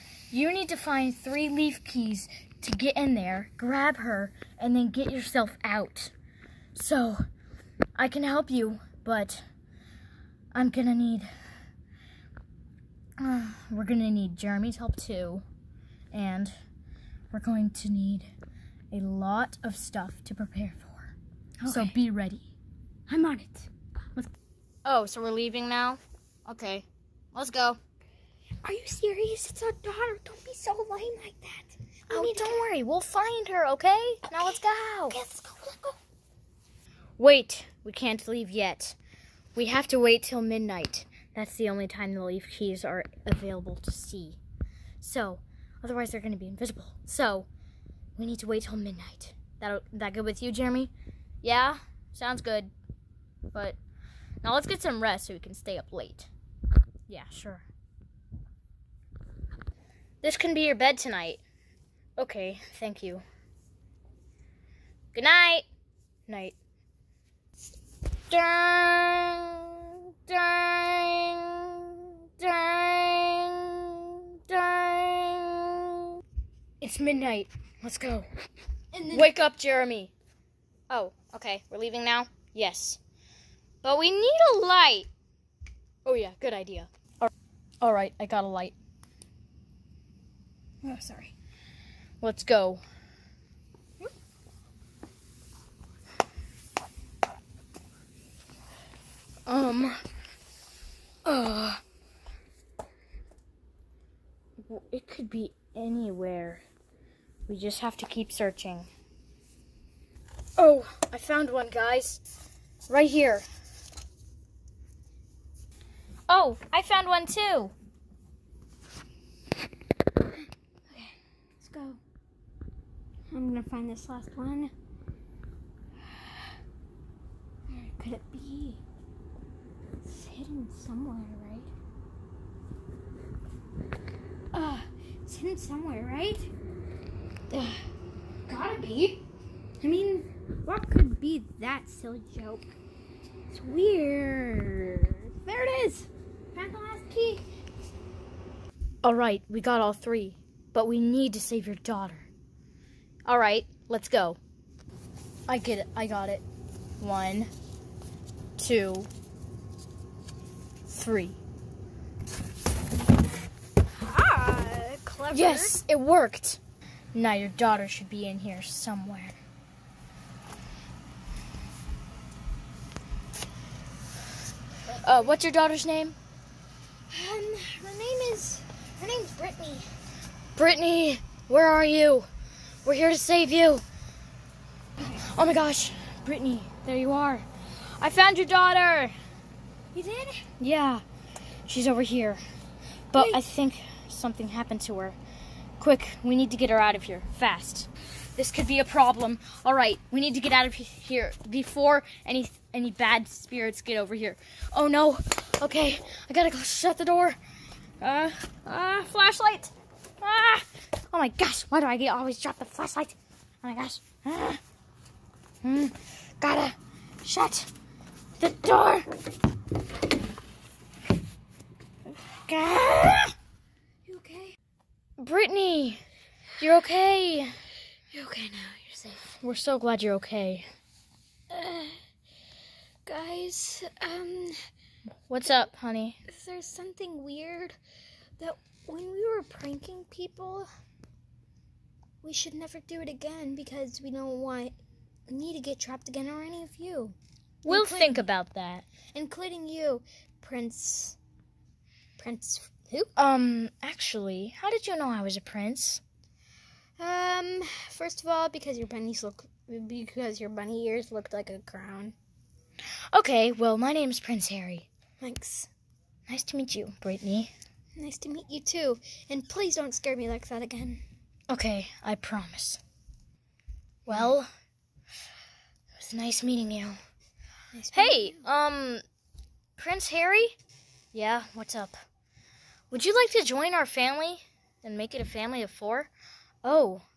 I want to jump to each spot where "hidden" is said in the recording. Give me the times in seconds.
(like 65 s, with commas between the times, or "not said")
130 s, 135 s.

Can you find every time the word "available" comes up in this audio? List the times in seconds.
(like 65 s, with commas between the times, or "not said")
43 s.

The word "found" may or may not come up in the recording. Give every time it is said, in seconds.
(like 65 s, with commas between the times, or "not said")
111 s, 116 s, 188 s.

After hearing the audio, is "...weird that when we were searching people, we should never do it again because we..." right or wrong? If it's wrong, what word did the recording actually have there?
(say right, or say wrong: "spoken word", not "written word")
wrong: "pranking", not "searching".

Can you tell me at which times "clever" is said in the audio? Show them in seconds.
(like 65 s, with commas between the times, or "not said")
165 s.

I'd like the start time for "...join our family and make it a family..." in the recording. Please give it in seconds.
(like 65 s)
283 s.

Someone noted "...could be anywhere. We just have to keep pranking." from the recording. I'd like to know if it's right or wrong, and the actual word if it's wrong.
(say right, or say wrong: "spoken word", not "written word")
wrong: "searching", not "pranking".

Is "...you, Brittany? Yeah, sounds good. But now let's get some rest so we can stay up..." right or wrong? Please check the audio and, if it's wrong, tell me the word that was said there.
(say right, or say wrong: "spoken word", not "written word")
wrong: "Jeremy", not "Brittany".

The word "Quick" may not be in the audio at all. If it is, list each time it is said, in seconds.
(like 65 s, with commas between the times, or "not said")
195 s.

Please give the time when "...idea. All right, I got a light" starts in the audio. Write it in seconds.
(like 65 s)
86 s.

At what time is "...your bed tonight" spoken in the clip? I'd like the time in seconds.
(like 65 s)
60 s.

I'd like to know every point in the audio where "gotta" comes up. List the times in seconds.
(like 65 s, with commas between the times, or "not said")
138 s, 206 s, 216 s.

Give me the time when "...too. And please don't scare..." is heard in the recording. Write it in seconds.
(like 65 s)
268 s.